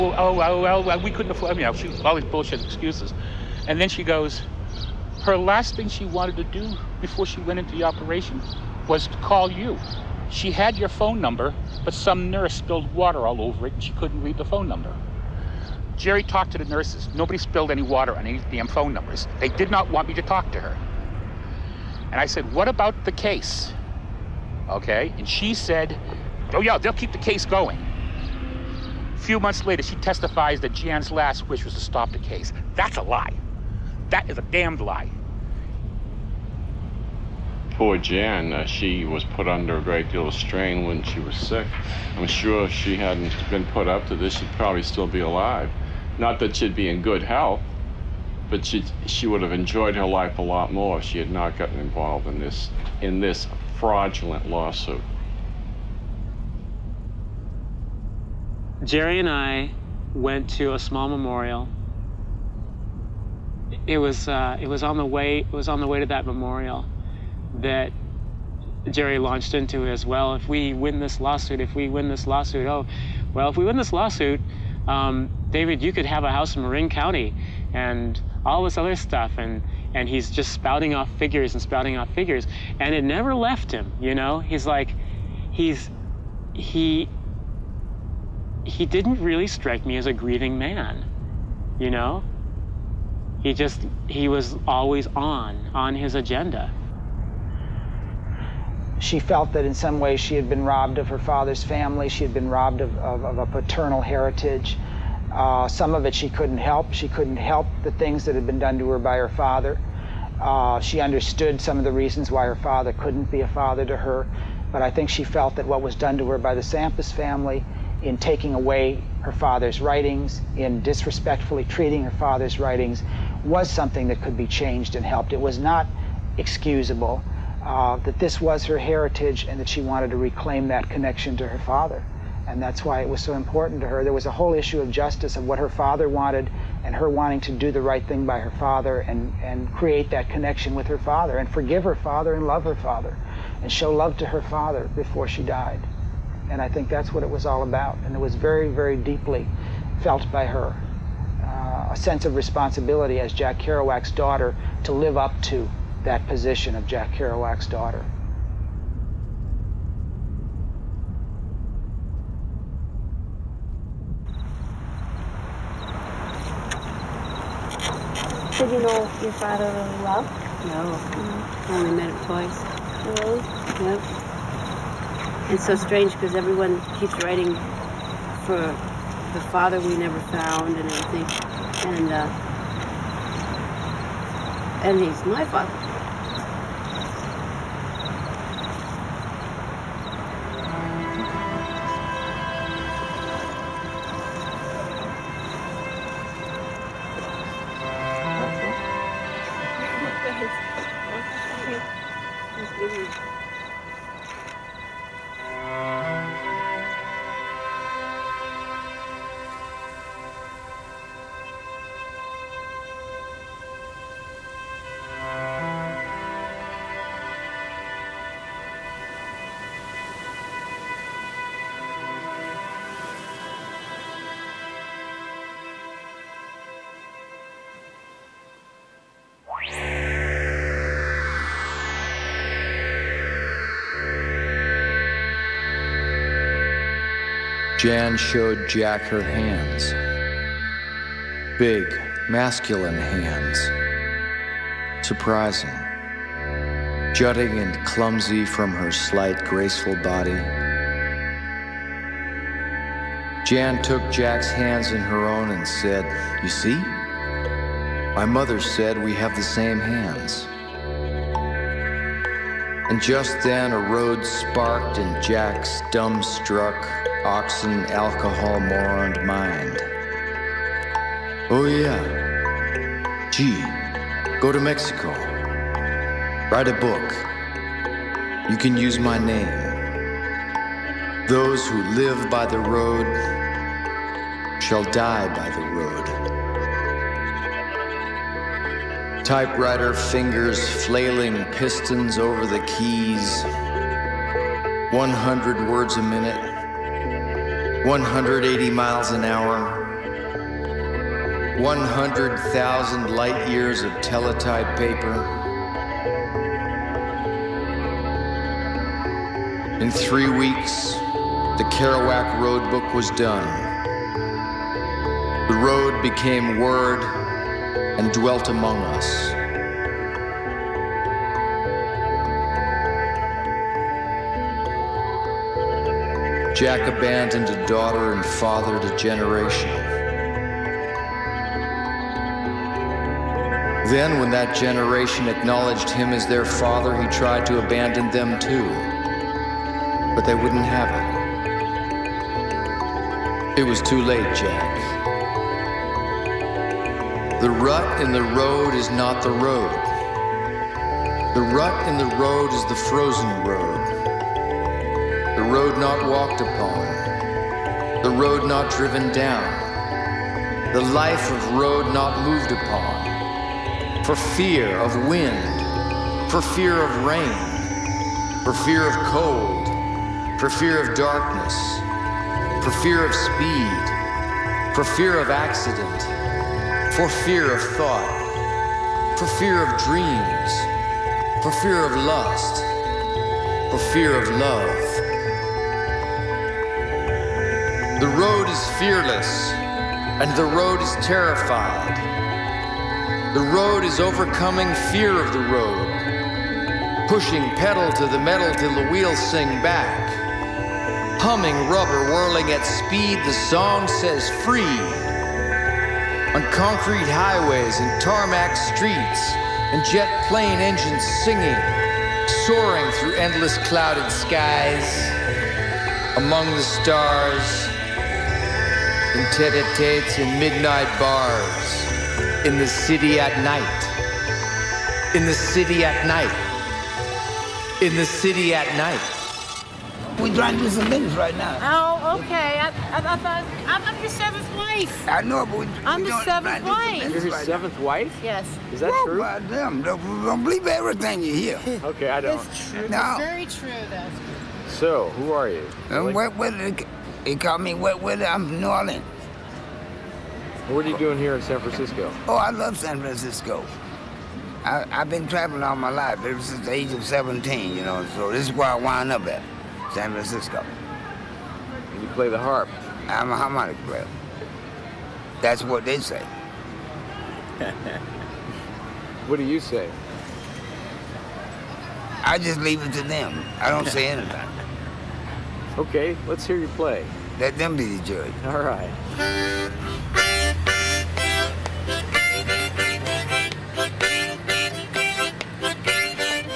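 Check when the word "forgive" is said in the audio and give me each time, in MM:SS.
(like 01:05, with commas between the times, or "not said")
02:21.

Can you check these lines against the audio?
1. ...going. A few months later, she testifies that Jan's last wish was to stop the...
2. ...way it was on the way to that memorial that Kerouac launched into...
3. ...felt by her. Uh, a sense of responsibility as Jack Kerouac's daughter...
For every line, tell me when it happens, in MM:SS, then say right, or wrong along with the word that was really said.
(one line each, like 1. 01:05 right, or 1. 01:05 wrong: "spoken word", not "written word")
1. 00:27 right
2. 01:05 wrong: "Jerry", not "Kerouac"
3. 02:30 right.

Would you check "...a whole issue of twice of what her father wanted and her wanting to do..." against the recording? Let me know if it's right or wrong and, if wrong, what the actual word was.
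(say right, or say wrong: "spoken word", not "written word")
wrong: "justice", not "twice".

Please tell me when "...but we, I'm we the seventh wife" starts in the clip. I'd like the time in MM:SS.
07:15.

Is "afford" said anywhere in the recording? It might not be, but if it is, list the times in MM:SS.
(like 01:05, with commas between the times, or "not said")
00:01.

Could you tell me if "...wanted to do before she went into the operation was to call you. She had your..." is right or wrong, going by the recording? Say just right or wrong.
right.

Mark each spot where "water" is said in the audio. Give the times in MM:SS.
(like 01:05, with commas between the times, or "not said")
00:12, 00:17.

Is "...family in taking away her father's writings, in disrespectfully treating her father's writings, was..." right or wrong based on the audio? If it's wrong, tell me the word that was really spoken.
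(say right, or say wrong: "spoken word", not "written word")
right.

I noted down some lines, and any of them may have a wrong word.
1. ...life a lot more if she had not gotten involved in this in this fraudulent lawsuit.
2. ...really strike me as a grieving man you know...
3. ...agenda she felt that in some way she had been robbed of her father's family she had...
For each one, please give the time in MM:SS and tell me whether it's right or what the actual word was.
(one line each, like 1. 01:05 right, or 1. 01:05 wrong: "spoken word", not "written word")
1. 00:50 right
2. 01:29 right
3. 01:36 right.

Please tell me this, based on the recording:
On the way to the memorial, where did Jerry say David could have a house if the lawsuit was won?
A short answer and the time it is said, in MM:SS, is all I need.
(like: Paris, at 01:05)
Marin County, at 01:16.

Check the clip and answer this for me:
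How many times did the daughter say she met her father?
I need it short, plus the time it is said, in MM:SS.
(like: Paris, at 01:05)
2, at 02:52.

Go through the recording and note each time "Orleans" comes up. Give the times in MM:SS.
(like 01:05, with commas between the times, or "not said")
07:28.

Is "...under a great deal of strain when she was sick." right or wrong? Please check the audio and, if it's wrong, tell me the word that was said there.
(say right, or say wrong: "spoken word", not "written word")
right.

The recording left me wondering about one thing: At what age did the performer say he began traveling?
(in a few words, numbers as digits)
17.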